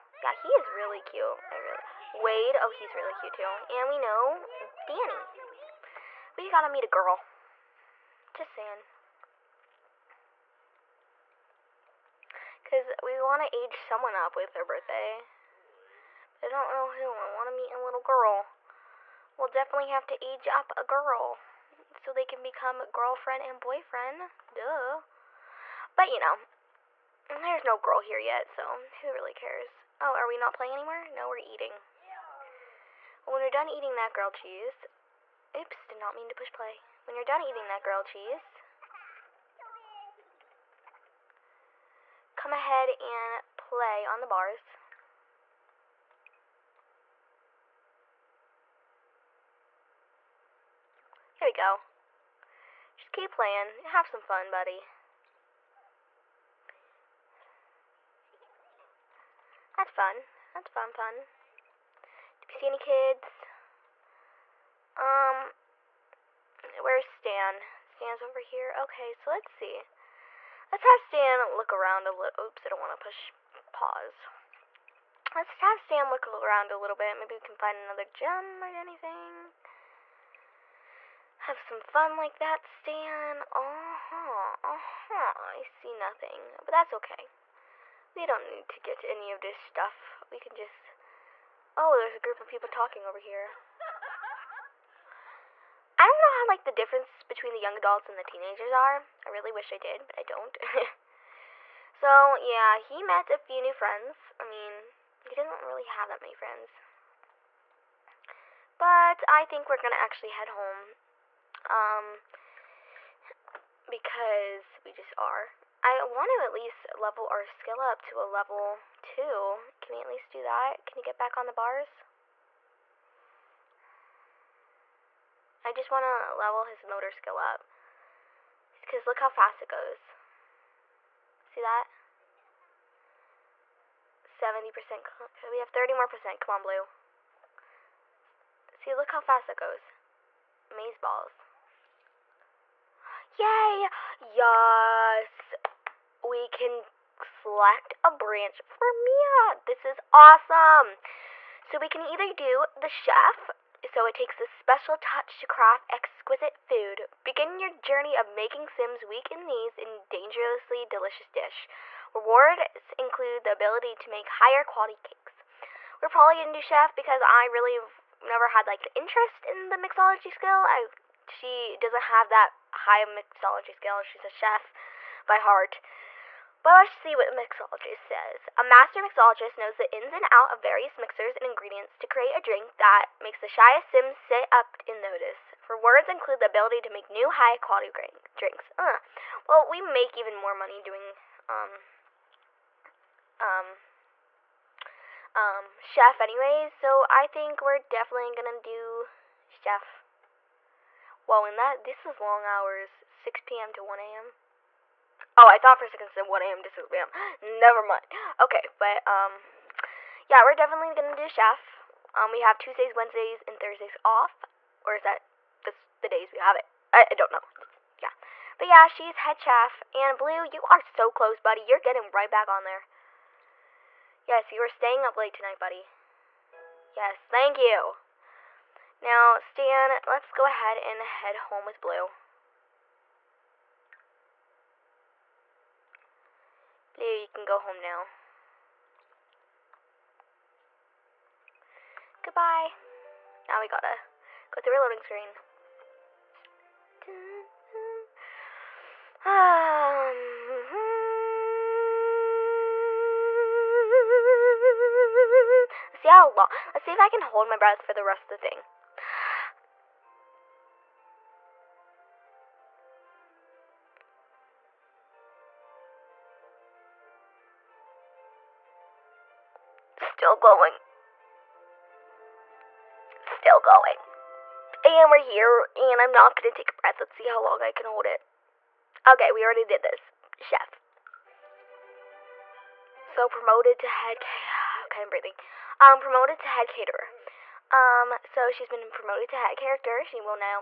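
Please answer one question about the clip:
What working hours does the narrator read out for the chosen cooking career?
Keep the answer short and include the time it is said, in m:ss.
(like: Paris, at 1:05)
6 p.m. to 1 a.m., at 3:23.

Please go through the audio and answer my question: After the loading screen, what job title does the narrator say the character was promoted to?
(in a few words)
Head caterer.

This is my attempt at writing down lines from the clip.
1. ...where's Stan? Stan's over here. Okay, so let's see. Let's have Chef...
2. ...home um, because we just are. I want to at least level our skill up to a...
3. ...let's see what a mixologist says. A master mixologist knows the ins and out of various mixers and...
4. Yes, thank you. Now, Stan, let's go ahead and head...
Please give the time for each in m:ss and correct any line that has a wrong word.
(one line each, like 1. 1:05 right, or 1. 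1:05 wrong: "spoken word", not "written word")
1. 1:06 wrong: "Stan", not "Chef"
2. 1:50 right
3. 2:56 right
4. 3:46 right.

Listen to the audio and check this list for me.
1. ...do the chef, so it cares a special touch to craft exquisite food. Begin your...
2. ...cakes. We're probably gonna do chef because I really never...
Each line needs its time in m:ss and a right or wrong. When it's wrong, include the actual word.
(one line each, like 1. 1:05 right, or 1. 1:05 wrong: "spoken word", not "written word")
1. 2:32 wrong: "takes", not "cares"
2. 2:45 right.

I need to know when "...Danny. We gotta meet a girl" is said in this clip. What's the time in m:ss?
0:04.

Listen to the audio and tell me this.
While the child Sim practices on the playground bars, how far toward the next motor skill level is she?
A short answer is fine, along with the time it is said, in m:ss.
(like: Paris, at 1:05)
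70%, at 2:14.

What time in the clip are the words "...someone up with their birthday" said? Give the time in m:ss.
0:13.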